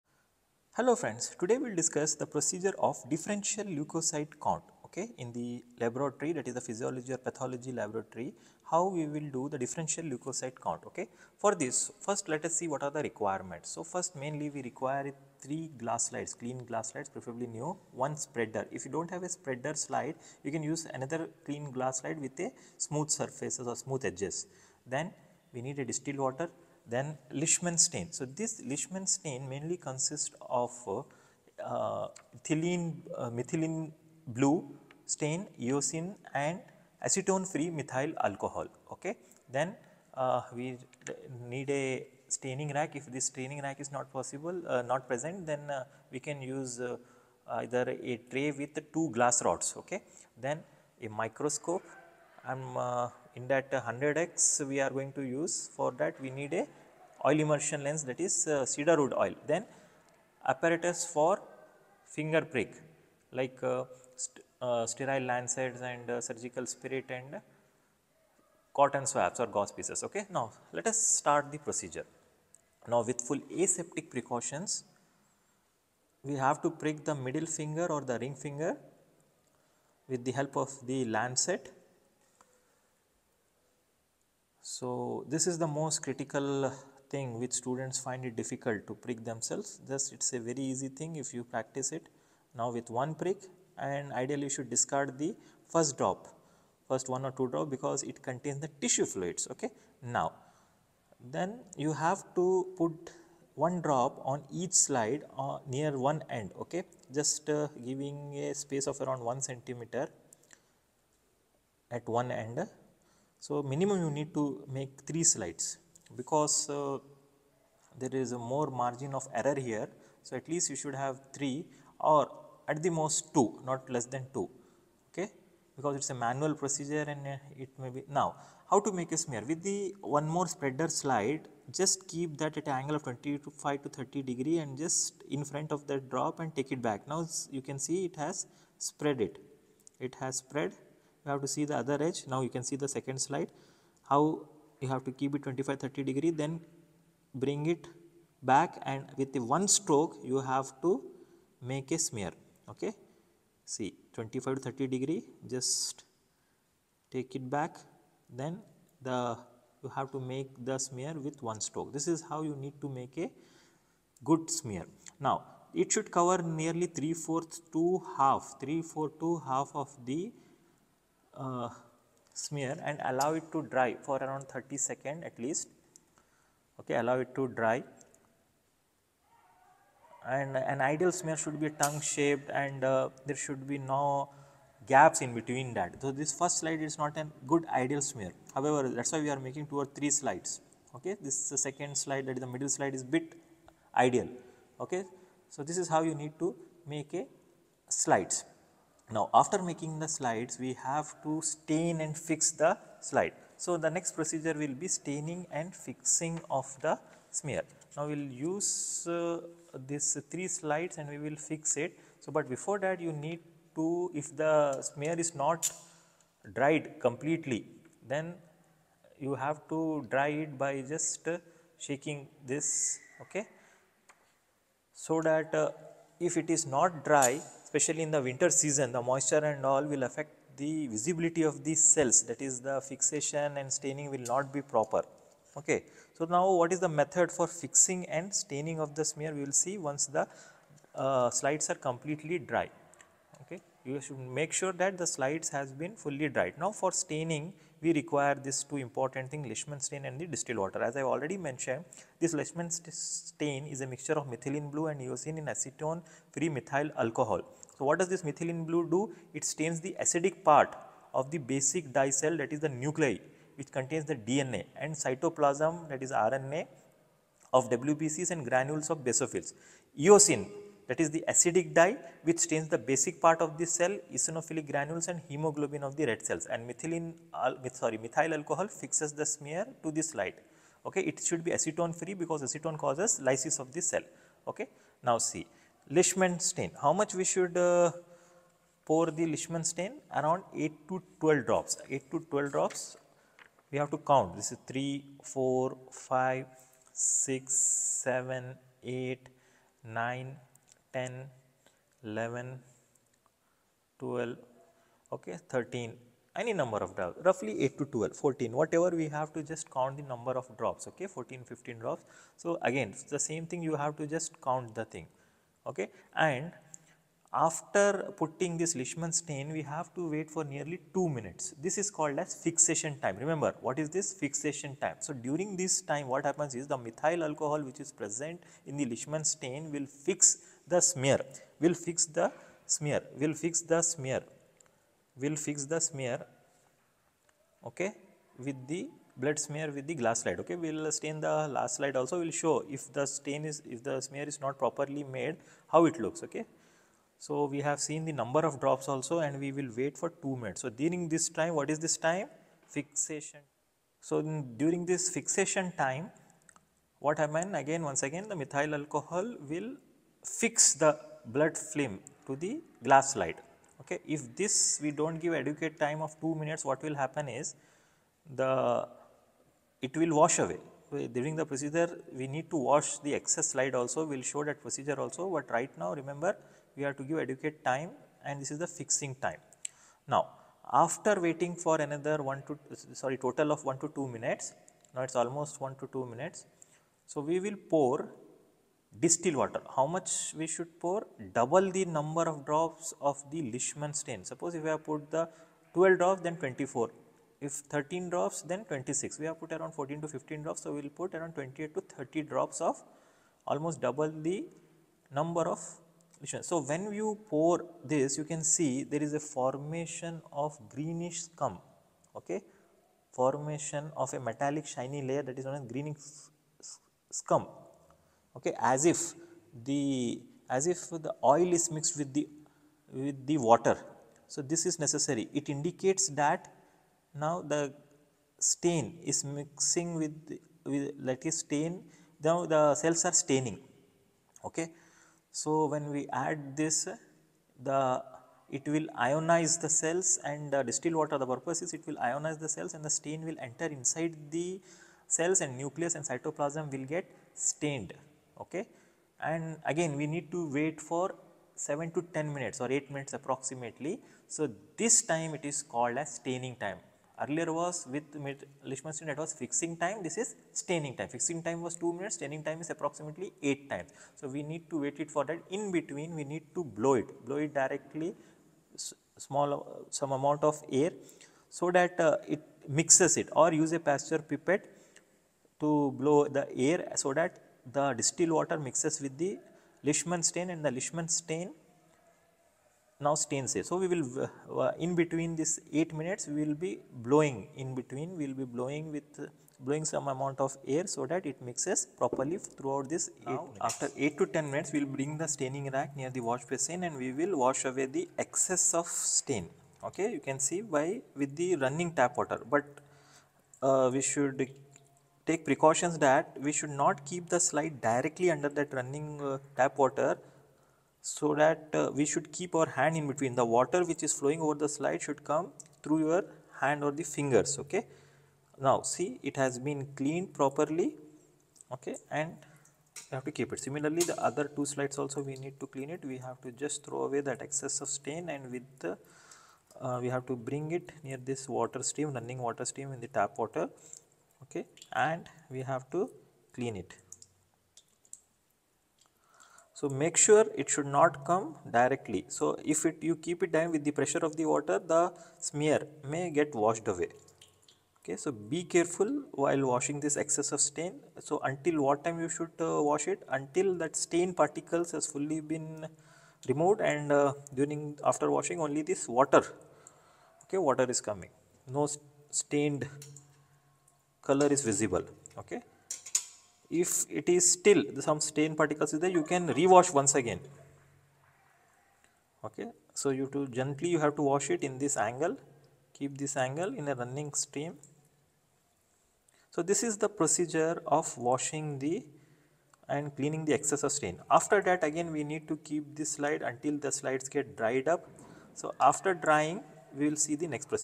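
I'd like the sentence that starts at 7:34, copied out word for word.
So, this time it is called as staining time.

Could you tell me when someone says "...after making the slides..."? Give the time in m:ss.
3:19.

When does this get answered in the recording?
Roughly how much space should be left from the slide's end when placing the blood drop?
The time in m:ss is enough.
1:49.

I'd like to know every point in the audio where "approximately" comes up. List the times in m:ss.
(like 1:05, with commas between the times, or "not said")
7:33, 7:42.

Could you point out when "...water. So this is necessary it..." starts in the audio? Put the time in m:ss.
7:03.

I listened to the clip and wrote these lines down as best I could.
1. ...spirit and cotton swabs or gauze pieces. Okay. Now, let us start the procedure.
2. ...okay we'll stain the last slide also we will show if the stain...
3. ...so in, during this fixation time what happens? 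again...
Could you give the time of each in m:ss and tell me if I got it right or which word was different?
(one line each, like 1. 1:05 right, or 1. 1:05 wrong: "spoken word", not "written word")
1. 1:06 right
2. 5:40 right
3. 5:53 right.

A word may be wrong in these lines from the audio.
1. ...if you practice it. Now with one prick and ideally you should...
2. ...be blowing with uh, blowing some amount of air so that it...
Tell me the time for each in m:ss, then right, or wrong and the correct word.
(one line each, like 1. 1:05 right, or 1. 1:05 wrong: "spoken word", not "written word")
1. 1:31 right
2. 8:08 right.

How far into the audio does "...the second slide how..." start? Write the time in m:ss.
2:22.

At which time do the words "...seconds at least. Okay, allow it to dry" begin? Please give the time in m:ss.
2:54.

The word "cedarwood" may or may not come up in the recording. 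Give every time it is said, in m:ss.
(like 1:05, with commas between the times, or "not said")
0:58.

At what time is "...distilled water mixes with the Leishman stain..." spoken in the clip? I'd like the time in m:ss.
7:57.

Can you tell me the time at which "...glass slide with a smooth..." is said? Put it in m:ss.
0:21.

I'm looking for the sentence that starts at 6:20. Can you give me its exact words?
Now, after waiting for another 1 to, sorry, total of 1 to 2 minutes, now it is almost 1 to 2 minutes.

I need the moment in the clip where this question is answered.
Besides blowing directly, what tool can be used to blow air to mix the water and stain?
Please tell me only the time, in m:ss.
7:53.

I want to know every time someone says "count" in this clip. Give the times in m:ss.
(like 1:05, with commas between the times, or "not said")
0:04, 0:10, 4:53, 5:09, 5:14.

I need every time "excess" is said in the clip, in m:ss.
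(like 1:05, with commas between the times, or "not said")
6:13, 8:18, 8:47, 9:10, 9:43.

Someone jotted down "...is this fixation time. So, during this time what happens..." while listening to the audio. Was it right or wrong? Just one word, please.
right.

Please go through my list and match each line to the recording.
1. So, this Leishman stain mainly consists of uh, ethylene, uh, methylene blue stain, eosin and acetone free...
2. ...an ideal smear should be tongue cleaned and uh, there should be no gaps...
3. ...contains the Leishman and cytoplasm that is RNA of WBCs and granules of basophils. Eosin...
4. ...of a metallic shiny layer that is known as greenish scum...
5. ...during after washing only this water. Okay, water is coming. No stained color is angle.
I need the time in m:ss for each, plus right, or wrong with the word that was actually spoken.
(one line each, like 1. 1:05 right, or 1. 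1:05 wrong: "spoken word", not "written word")
1. 0:28 right
2. 3:00 wrong: "shaped", not "cleaned"
3. 4:23 wrong: "DNA", not "Leishman"
4. 6:54 right
5. 9:17 wrong: "visible", not "angle".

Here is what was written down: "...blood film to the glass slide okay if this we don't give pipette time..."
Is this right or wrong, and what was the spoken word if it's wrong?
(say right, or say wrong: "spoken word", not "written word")
wrong: "adequate", not "pipette".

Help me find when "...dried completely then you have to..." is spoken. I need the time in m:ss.
3:36.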